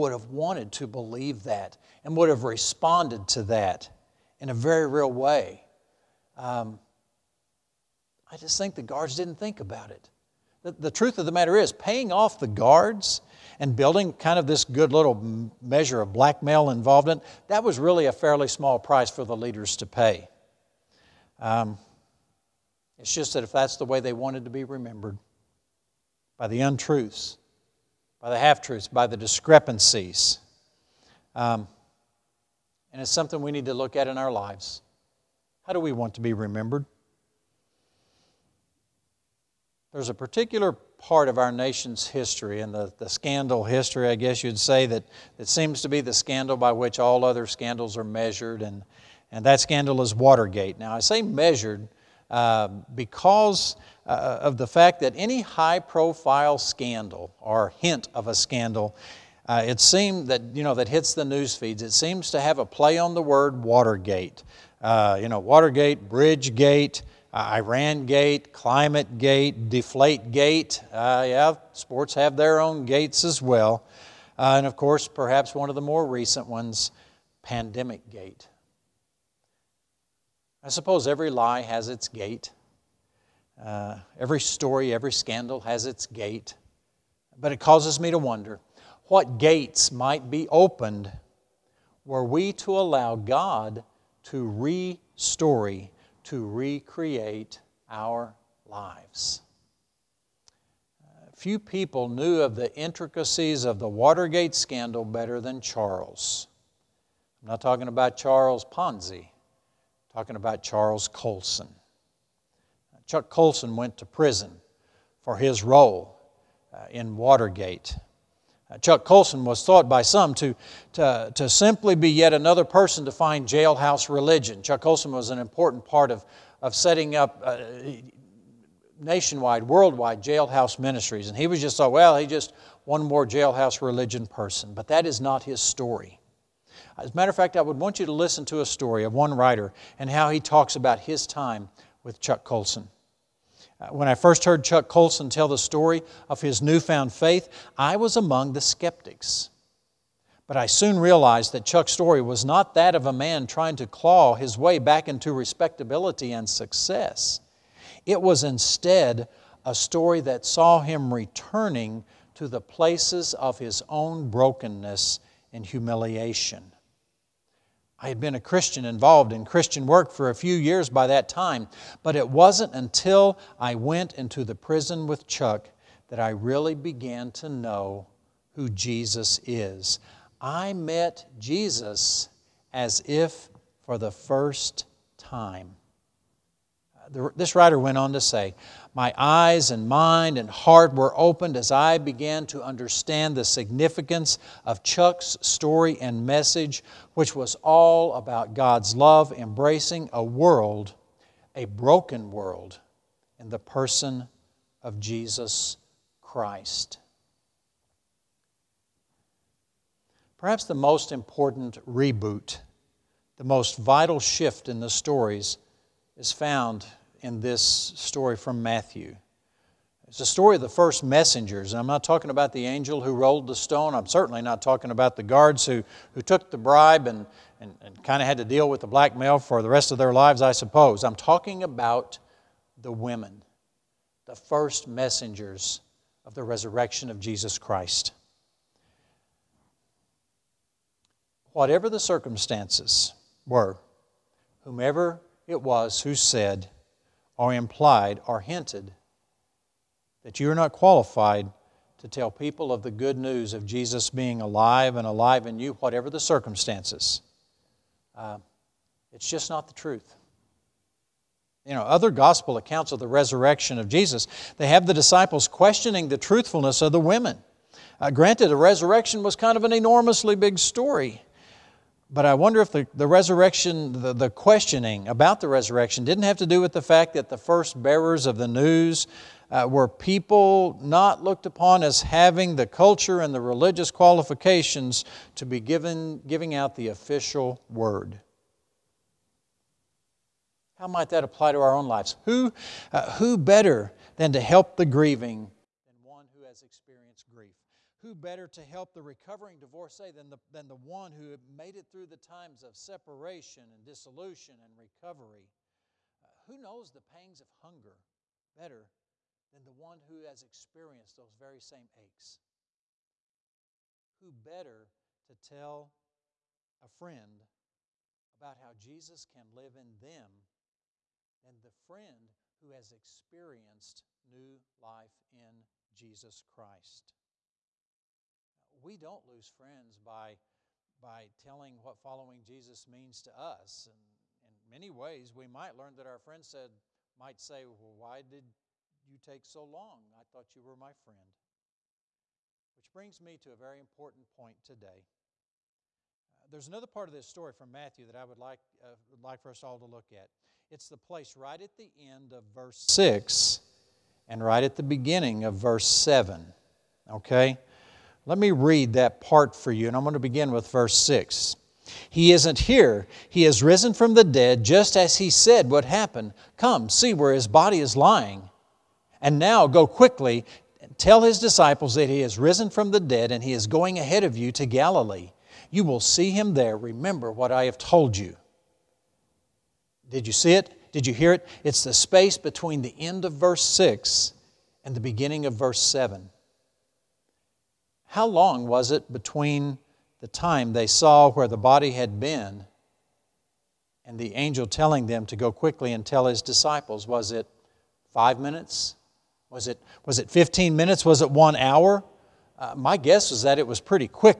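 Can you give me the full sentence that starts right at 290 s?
How might that apply to our own lives?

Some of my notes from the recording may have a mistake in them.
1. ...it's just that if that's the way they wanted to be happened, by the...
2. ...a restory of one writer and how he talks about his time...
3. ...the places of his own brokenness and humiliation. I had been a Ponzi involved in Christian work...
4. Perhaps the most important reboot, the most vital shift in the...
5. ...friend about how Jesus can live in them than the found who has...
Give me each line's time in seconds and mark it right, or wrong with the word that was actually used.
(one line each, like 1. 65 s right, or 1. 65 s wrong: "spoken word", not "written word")
1. 22 s wrong: "remembered", not "happened"
2. 138 s wrong: "story", not "restory"
3. 162 s wrong: "Christian", not "Ponzi"
4. 210 s right
5. 316 s wrong: "friend", not "found".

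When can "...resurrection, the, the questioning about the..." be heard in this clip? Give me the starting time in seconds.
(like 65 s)
273 s.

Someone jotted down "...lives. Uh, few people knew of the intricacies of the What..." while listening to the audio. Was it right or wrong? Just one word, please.
wrong.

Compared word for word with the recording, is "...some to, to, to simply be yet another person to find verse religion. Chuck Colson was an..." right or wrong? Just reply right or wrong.
wrong.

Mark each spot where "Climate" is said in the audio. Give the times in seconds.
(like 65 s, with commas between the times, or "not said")
68 s.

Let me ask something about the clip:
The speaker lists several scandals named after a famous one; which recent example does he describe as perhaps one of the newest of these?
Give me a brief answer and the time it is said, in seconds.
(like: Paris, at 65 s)
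Pandemic Gate, at 77 s.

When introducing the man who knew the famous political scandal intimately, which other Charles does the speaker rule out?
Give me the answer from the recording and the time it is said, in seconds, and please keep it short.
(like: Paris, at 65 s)
Charles Ponzi, at 108 s.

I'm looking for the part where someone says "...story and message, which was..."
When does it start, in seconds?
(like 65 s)
195 s.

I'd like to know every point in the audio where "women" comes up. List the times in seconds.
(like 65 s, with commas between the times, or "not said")
232 s, 267 s.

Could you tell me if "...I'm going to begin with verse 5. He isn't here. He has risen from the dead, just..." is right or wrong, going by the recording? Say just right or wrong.
wrong.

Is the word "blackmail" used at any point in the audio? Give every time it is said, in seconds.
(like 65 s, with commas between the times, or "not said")
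16 s, 228 s.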